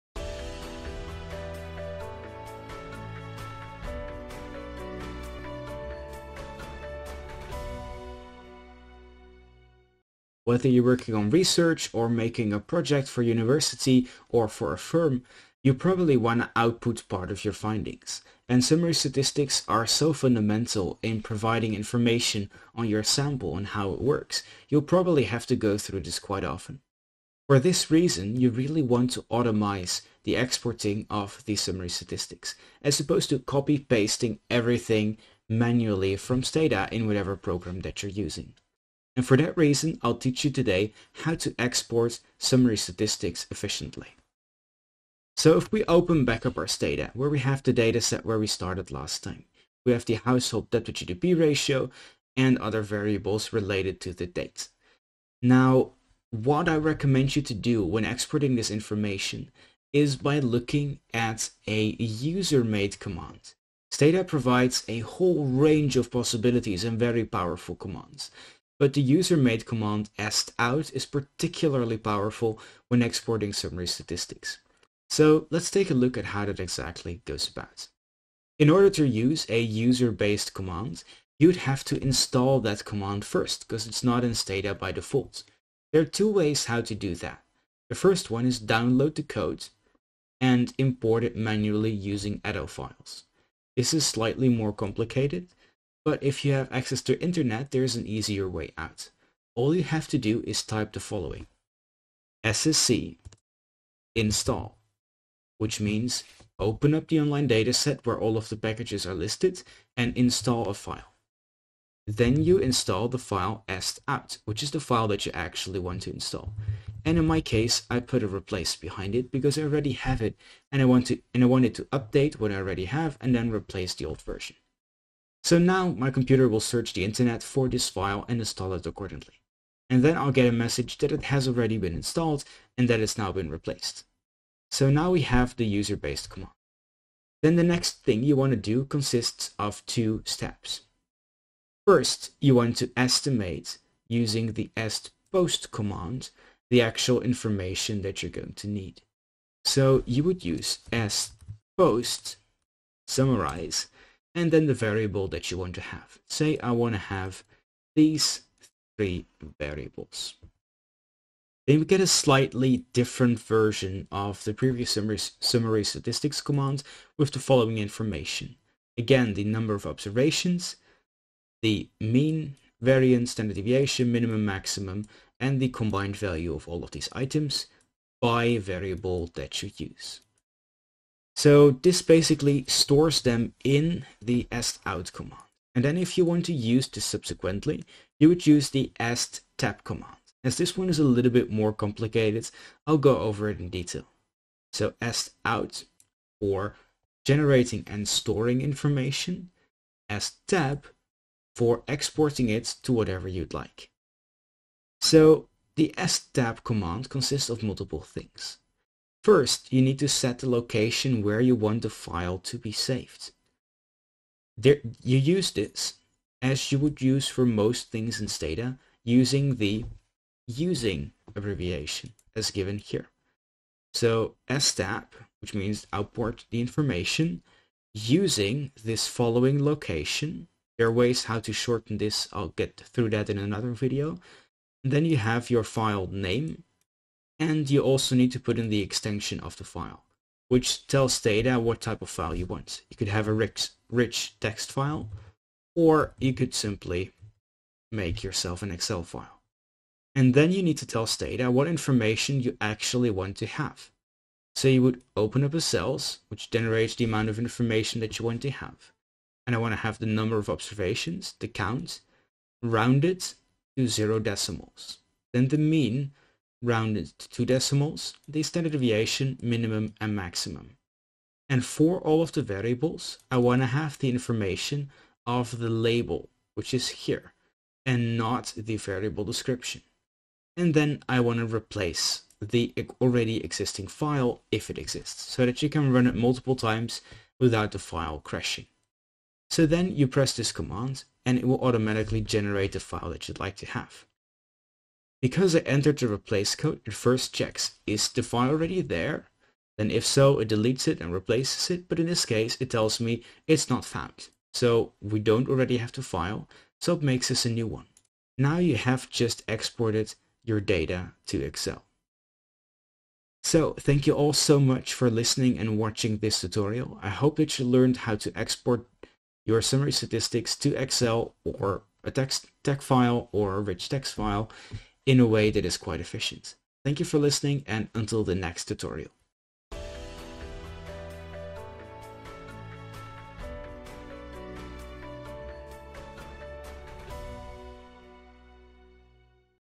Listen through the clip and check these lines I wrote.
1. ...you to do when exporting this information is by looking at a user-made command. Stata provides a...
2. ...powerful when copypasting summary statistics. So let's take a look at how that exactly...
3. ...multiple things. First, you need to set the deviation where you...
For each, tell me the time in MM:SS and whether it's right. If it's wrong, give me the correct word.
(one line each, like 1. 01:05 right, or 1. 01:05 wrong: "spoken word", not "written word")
1. 00:57 right
2. 01:11 wrong: "exporting", not "copypasting"
3. 03:27 wrong: "location", not "deviation".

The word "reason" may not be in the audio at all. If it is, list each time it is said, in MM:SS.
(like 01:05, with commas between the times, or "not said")
00:27, 00:39.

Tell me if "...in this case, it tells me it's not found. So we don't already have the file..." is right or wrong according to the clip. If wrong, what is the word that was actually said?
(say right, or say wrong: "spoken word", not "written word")
right.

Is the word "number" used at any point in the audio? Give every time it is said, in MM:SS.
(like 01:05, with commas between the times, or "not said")
02:49, 04:20.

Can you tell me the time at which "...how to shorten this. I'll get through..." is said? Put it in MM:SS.
03:51.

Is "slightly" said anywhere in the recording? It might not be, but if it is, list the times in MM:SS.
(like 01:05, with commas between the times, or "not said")
01:34, 02:42.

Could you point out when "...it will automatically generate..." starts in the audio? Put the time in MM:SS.
04:51.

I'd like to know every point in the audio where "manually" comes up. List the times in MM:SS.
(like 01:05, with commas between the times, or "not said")
00:35, 01:31.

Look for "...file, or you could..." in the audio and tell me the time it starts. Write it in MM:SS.
04:04.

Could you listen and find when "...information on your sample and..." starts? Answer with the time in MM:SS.
00:21.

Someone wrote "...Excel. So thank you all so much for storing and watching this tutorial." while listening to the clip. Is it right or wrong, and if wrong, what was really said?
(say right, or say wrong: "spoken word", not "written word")
wrong: "listening", not "storing".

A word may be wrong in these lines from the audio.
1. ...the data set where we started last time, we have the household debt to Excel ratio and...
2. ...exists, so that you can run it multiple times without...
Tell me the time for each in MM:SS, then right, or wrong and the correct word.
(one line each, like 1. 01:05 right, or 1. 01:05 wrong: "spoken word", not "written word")
1. 00:47 wrong: "GDP", not "Excel"
2. 04:44 right.